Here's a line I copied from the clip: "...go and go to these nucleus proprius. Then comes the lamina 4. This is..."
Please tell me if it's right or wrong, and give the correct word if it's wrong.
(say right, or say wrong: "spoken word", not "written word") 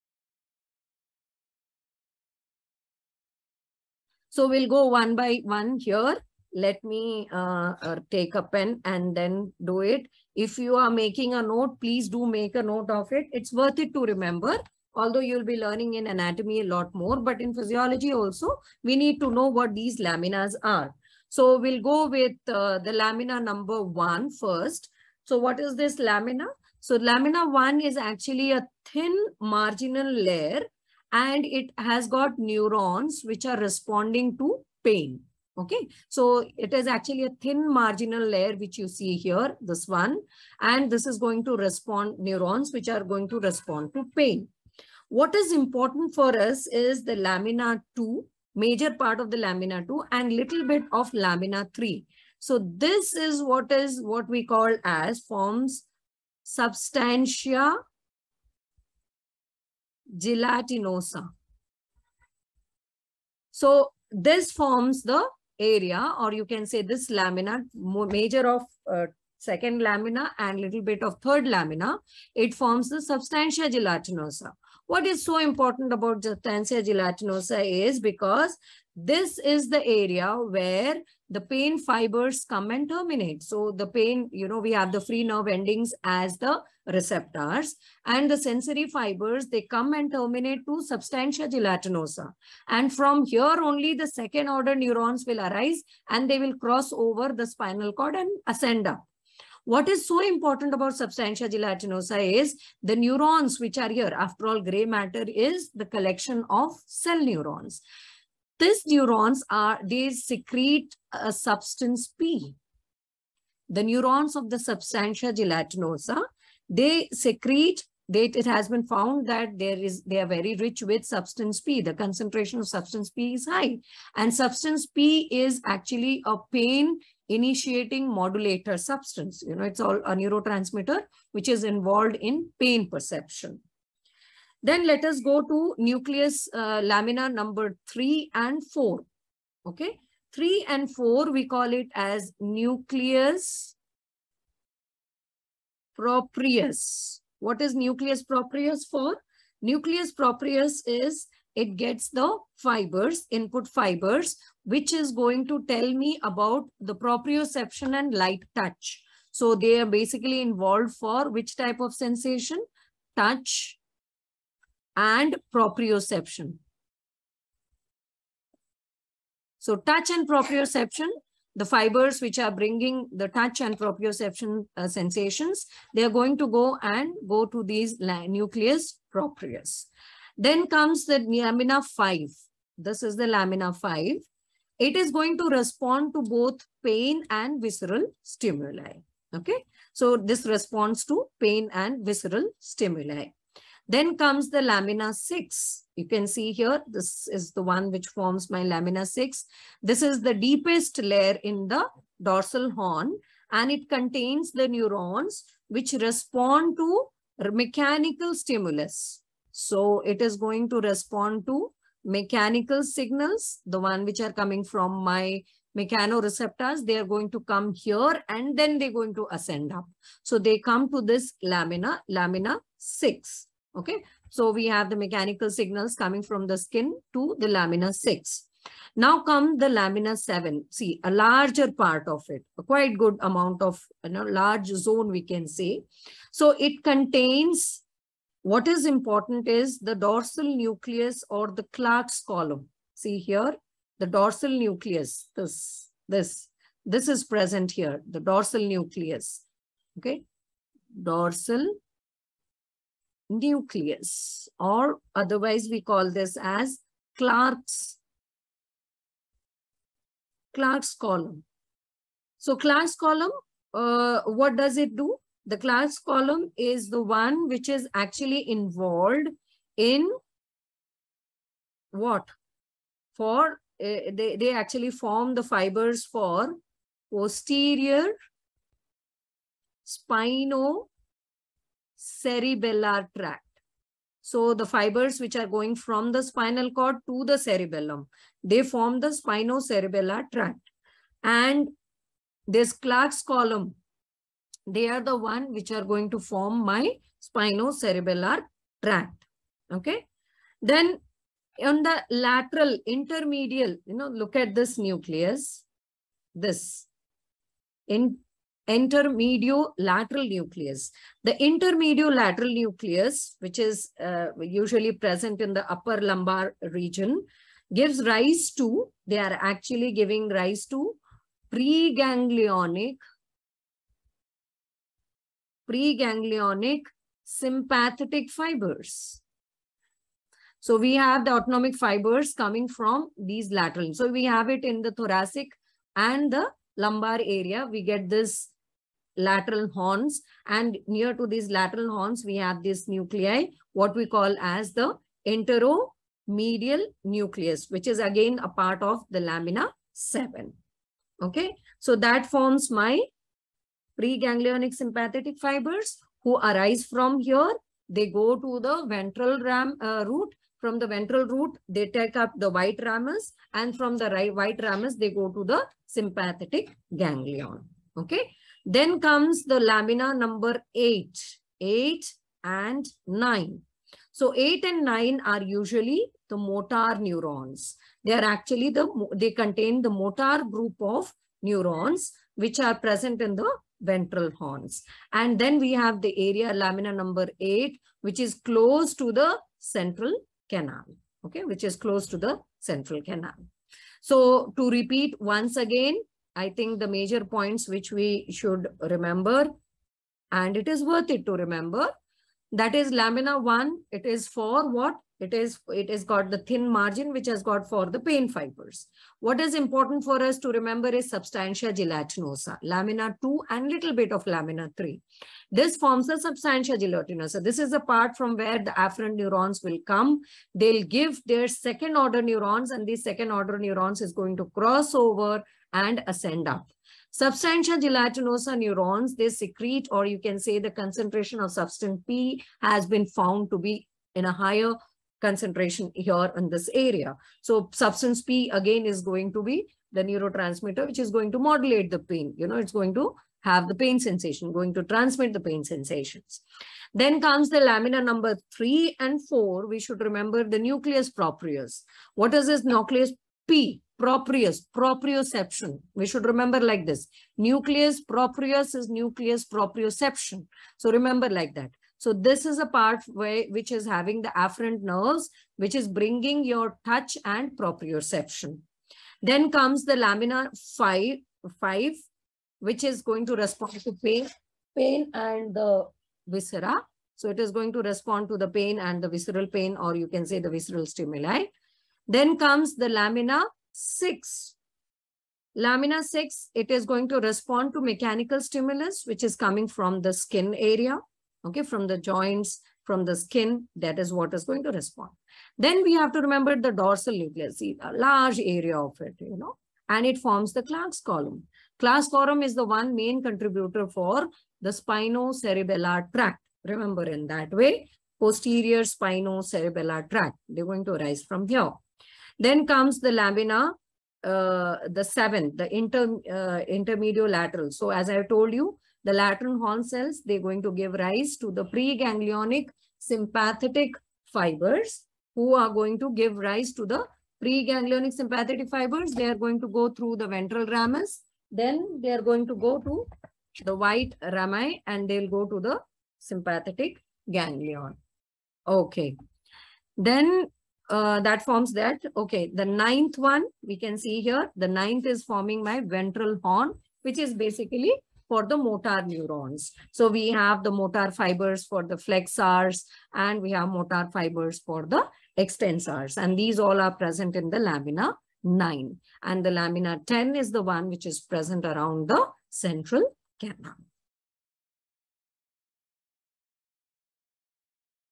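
wrong: "5", not "4".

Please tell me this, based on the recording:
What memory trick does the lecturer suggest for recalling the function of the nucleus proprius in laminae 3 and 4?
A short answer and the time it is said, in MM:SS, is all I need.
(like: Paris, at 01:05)
Nucleus proprioception, at 07:38.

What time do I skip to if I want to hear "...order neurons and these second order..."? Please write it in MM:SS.
07:01.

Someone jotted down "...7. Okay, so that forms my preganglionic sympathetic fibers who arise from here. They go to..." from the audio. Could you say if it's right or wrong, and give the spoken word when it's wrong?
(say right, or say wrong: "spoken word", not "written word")
right.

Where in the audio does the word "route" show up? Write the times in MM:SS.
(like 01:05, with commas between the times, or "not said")
not said.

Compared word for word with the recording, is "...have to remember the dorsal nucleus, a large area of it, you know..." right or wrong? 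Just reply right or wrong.
right.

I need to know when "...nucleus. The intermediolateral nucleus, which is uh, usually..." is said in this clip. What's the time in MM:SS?
05:10.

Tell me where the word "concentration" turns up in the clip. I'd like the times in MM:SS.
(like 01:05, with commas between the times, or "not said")
02:01, 07:10, 07:15.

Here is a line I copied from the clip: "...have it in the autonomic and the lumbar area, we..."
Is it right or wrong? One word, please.
wrong.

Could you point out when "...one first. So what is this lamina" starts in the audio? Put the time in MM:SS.
00:23.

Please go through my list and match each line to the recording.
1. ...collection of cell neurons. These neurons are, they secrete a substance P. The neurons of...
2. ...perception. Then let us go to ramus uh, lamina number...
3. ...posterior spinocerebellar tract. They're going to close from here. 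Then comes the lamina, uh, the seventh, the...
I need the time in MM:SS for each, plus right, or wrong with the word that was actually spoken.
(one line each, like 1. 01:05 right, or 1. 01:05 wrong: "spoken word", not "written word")
1. 01:45 right
2. 02:12 wrong: "nucleus", not "ramus"
3. 08:28 wrong: "arise", not "close".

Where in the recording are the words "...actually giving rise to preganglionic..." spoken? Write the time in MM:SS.
05:19.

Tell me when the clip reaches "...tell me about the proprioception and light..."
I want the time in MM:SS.
02:35.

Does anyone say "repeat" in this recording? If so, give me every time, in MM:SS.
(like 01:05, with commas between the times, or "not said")
06:34.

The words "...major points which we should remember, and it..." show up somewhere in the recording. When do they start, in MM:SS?
06:36.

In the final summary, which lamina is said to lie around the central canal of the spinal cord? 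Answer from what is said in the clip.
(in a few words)
Lamina 10.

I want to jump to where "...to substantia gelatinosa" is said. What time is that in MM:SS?
01:30.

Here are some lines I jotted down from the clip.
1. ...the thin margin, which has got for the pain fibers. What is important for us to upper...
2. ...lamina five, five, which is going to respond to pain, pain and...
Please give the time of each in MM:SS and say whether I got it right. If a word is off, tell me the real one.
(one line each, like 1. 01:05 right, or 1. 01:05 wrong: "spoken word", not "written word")
1. 06:46 wrong: "remember", not "upper"
2. 07:49 right.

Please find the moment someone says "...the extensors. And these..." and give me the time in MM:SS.
09:14.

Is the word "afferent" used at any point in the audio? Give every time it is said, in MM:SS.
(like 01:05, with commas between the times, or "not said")
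06:58, 07:44.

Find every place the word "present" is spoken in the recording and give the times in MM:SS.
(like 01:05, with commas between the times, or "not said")
04:07, 05:14, 06:22, 09:16, 09:21.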